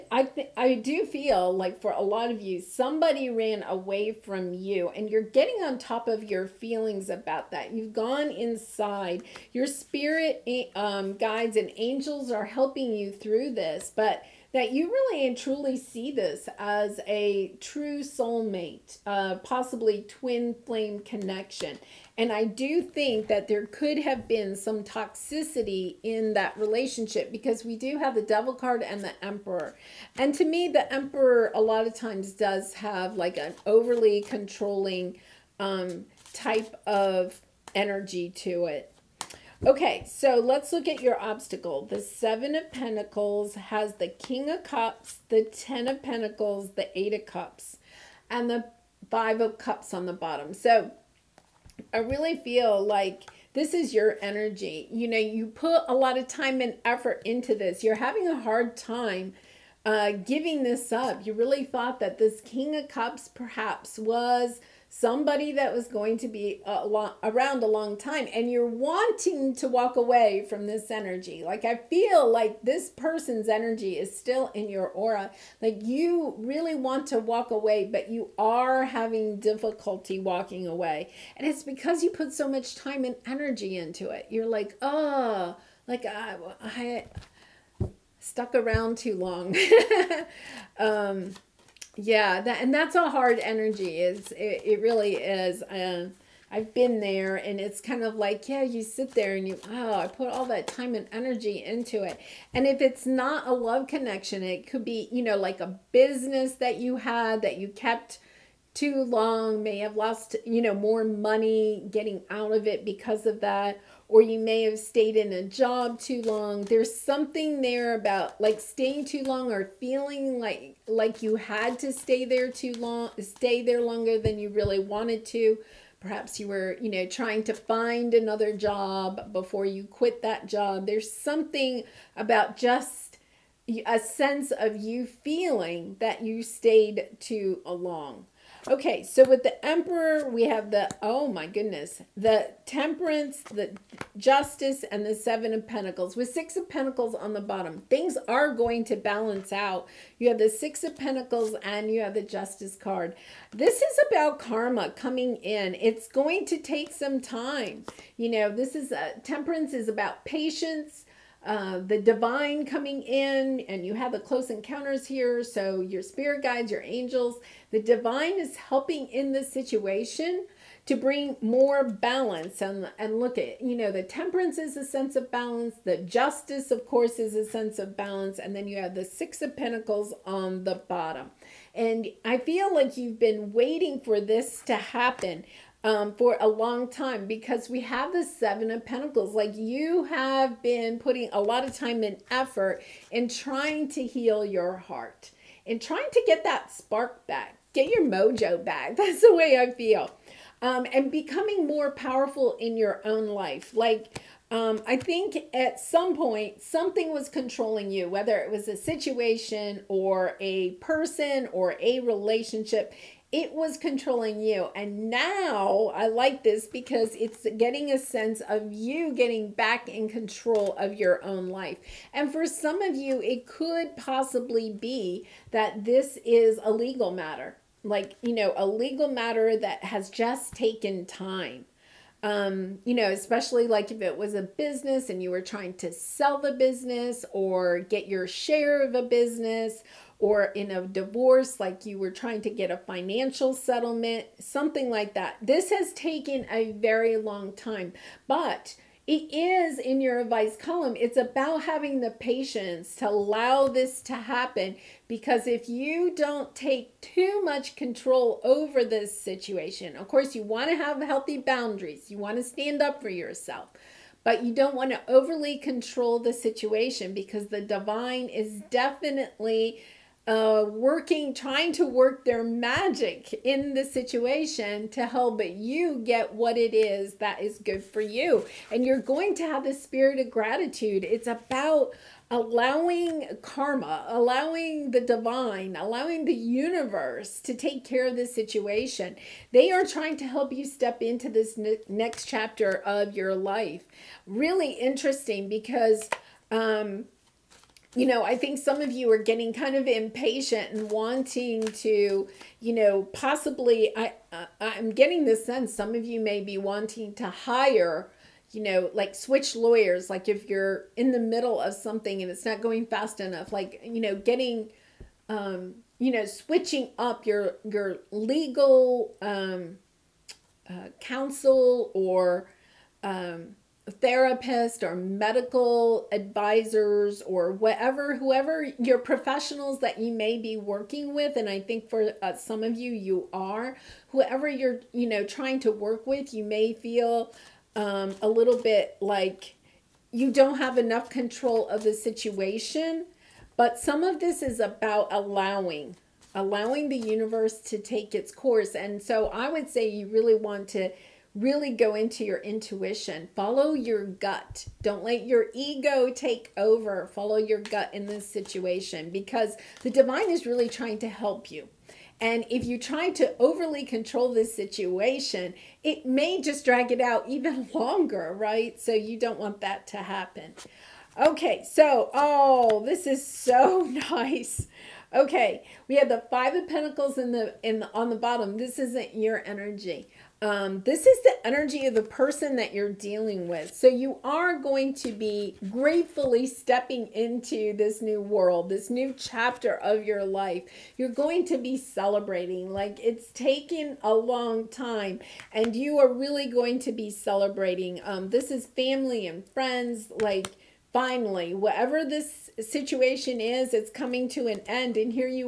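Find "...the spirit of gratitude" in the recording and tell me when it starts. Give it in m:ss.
4:39.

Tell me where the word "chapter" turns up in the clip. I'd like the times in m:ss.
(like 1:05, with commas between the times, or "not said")
4:52, 6:29.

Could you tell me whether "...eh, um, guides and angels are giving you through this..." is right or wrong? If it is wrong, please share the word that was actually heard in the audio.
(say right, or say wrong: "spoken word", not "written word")
wrong: "helping", not "giving".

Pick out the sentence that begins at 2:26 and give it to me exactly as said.
With six of pentacles on the bottom, things are going to balance out.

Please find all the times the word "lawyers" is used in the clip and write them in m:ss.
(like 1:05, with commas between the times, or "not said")
5:09.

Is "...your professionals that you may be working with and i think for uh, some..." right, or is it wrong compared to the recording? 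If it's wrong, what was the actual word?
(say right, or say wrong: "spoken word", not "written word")
right.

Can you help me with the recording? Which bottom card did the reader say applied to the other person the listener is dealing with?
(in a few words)
Five of Pentacles.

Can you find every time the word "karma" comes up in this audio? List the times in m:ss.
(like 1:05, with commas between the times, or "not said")
2:34, 4:43.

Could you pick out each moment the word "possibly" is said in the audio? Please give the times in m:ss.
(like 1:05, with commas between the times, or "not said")
0:19, 3:43, 5:03.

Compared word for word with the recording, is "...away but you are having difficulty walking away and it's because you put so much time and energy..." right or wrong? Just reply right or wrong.
right.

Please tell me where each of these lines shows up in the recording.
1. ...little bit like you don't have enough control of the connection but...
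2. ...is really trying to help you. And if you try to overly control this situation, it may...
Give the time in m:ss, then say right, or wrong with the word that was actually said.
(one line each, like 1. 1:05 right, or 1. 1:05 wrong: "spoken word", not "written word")
1. 5:38 wrong: "situation", not "connection"
2. 6:00 right.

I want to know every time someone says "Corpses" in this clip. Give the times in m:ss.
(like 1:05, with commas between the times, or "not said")
not said.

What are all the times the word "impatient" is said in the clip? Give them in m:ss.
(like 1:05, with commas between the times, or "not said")
4:59.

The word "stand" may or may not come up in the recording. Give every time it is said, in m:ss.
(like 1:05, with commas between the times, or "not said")
4:22.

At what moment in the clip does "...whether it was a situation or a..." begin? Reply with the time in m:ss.
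3:28.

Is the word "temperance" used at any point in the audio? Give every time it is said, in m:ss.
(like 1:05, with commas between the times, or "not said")
2:22, 2:39, 2:54.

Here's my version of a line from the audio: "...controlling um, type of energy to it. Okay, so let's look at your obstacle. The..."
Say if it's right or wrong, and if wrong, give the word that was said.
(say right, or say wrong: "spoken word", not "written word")
right.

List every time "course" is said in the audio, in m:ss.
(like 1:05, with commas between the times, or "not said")
2:56, 4:20, 5:48.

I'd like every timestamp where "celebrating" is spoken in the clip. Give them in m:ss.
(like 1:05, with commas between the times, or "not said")
6:31, 6:37.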